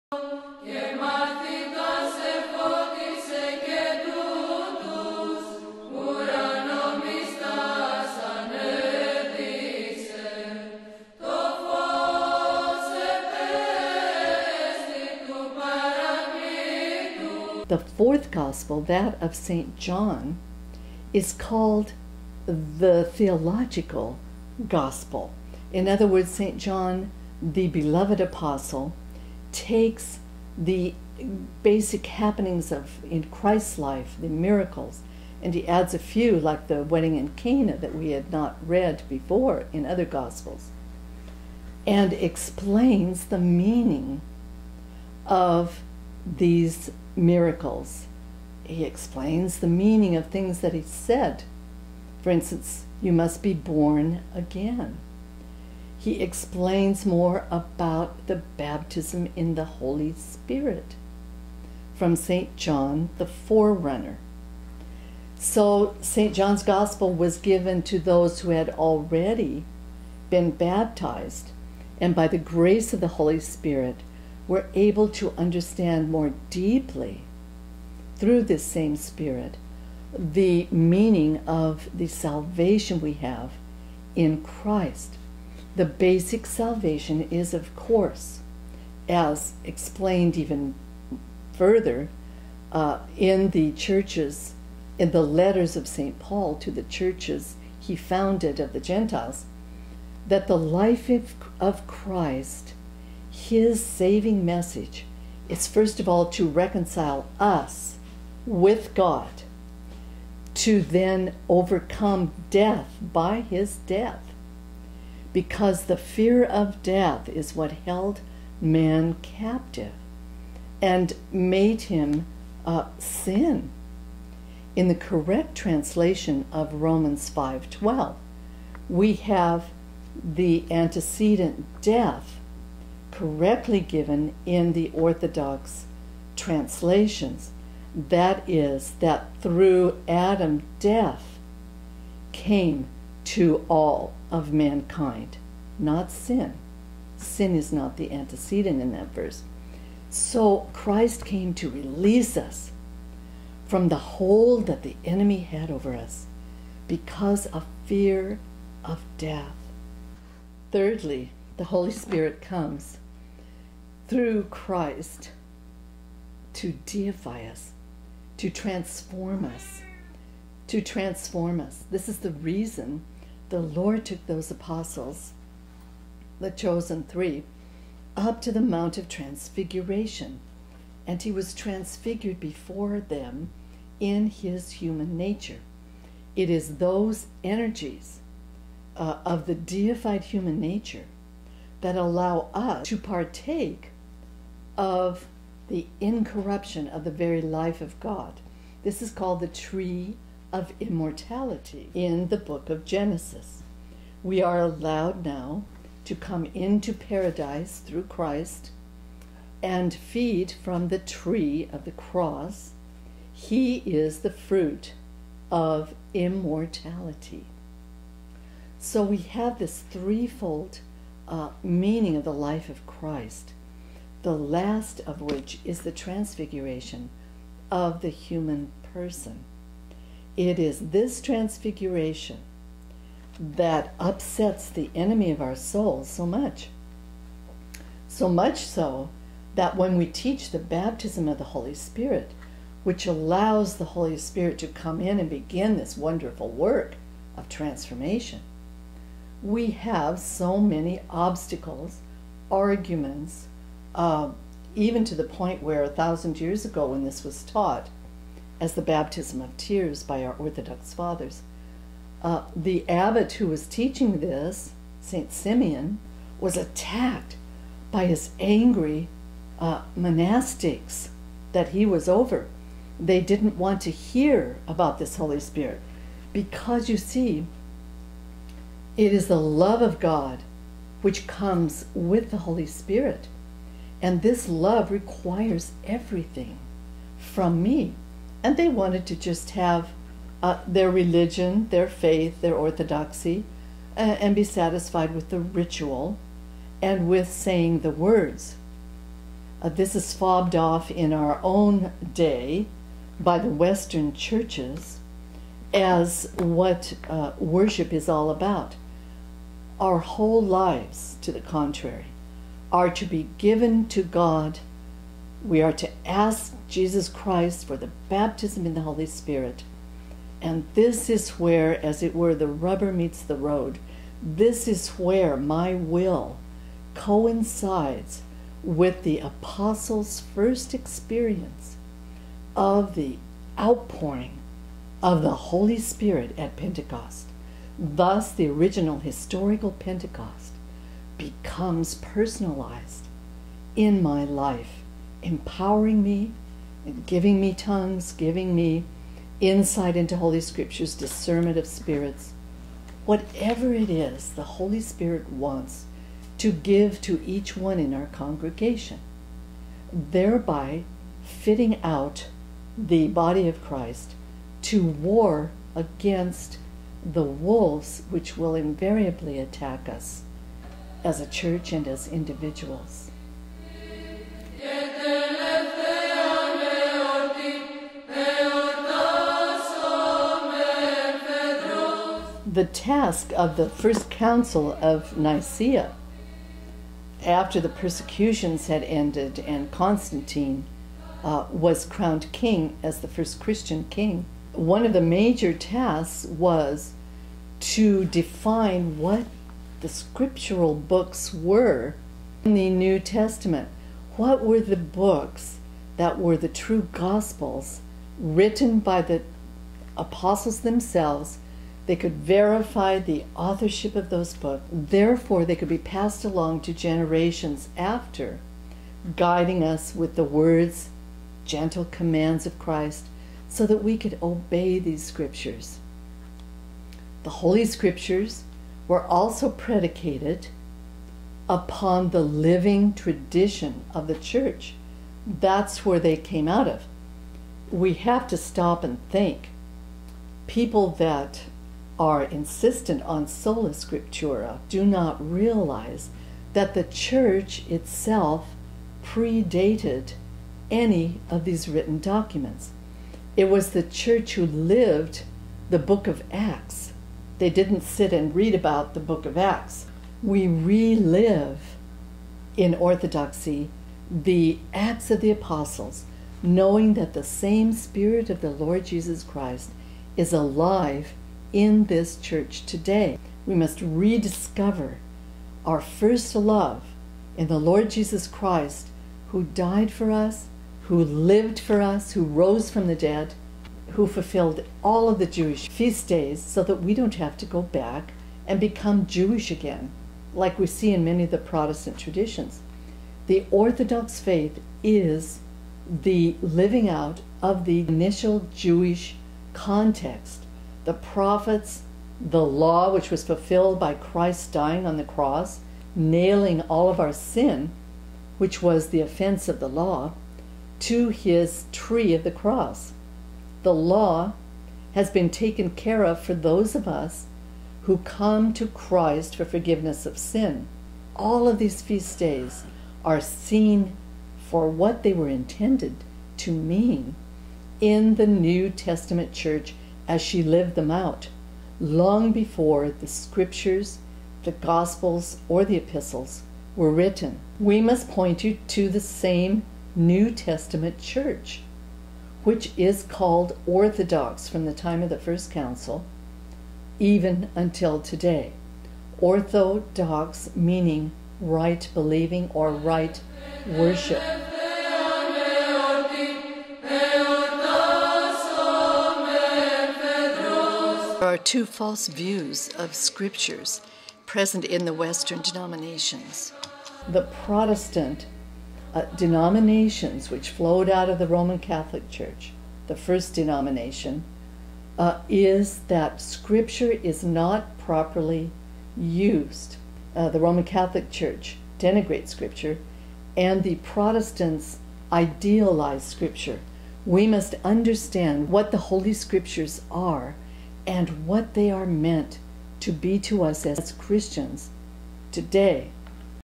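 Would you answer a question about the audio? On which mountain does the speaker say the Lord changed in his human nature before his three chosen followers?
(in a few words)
Mount of Transfiguration.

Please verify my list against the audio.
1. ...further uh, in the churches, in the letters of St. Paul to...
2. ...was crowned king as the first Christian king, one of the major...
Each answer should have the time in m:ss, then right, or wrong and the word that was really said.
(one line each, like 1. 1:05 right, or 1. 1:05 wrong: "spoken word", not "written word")
1. 1:31 right
2. 6:31 right.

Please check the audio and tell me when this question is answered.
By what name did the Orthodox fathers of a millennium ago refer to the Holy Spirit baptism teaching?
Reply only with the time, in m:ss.
4:18.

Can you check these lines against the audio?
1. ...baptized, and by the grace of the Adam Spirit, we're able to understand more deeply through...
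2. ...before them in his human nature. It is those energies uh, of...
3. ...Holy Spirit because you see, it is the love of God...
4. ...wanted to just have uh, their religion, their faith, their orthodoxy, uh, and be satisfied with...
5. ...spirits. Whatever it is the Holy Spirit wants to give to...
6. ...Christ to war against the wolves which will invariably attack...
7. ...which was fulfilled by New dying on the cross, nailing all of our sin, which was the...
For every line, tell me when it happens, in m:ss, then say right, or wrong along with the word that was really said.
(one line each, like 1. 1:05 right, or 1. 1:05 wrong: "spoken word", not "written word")
1. 1:10 wrong: "Holy", not "Adam"
2. 3:02 right
3. 4:35 right
4. 4:48 right
5. 5:51 right
6. 6:03 right
7. 8:22 wrong: "Christ", not "New".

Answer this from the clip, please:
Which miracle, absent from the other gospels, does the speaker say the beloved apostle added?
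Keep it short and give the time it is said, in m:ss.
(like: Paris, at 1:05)
wedding in Cana, at 0:36.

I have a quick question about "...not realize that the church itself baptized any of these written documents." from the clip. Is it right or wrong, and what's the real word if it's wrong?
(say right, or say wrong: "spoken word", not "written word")
wrong: "predated", not "baptized".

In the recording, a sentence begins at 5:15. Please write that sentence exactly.
We are to ask Jesus Christ for the baptism in the Holy Spirit.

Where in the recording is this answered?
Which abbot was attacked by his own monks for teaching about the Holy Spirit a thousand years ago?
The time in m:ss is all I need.
4:25.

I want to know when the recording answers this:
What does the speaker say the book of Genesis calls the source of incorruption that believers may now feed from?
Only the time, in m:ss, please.
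3:19.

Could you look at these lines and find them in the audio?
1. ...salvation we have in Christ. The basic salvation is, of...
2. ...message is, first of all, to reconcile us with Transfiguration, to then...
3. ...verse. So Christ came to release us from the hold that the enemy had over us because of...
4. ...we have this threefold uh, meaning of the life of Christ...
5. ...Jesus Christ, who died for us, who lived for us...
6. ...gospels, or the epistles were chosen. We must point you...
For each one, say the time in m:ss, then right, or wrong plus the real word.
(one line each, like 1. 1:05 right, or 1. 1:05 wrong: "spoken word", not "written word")
1. 1:22 right
2. 1:44 wrong: "God", not "Transfiguration"
3. 2:29 right
4. 3:39 right
5. 7:57 right
6. 8:54 wrong: "written", not "chosen".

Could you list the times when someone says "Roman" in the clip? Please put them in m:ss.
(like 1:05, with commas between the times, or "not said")
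2:06, 9:31, 9:40.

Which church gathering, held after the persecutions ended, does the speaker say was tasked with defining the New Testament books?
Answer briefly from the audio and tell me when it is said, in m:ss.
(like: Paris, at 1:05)
First Council of Nicaea, at 6:23.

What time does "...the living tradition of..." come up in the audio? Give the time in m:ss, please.
7:12.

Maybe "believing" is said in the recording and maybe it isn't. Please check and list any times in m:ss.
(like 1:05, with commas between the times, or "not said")
9:11.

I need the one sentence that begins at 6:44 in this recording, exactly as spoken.
What were the books that were the true gospels written by the apostles themselves?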